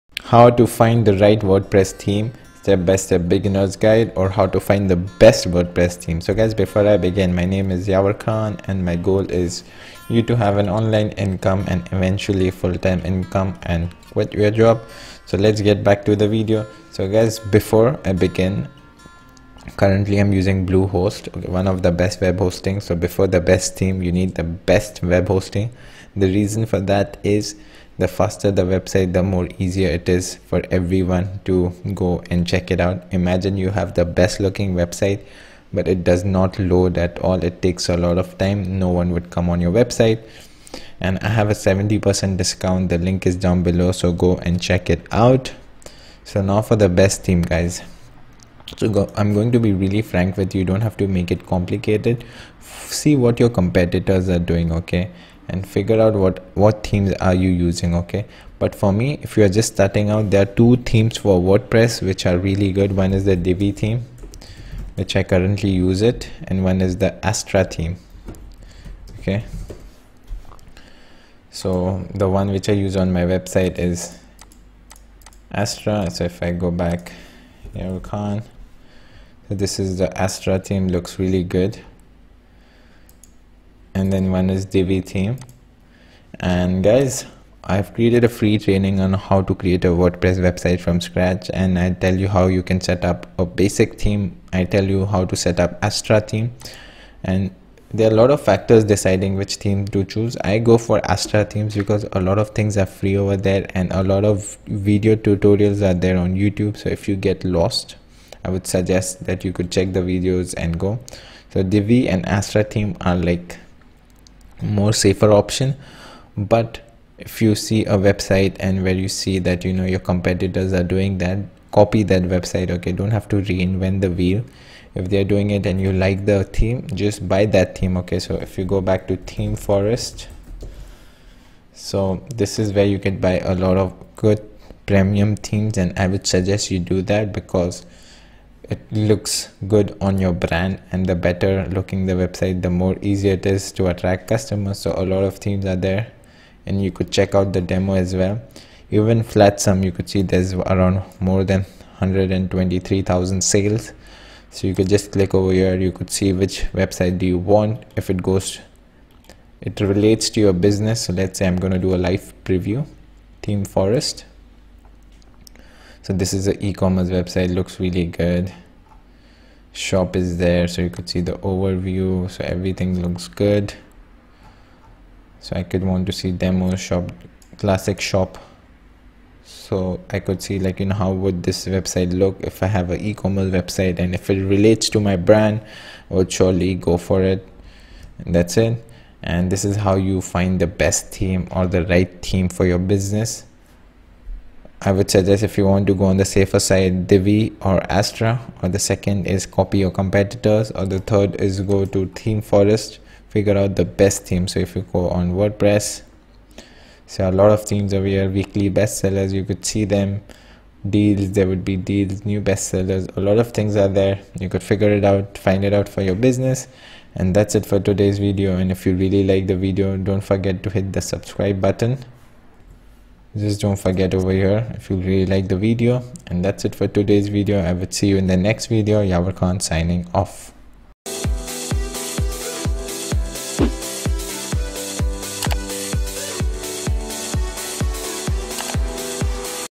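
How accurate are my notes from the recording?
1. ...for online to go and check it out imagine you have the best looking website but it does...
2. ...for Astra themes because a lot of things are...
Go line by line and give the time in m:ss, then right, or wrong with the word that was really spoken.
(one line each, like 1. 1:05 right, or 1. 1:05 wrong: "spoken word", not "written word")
1. 0:30 wrong: "everyone", not "online"
2. 1:40 right.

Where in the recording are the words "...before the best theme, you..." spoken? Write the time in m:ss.
0:22.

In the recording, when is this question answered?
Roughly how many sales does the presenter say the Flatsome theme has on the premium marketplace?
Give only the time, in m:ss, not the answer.
2:31.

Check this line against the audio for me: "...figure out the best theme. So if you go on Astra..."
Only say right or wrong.
wrong.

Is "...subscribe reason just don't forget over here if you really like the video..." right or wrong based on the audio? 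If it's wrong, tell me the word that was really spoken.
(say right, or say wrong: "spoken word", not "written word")
wrong: "button", not "reason".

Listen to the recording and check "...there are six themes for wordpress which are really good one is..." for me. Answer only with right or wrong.
wrong.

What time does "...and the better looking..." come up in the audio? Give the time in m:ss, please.
2:20.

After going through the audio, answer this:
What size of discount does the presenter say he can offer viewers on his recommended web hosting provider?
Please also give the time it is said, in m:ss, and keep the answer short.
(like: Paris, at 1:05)
70%, at 0:41.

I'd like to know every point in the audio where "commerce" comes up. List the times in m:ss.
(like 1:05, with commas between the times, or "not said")
2:46, 3:02.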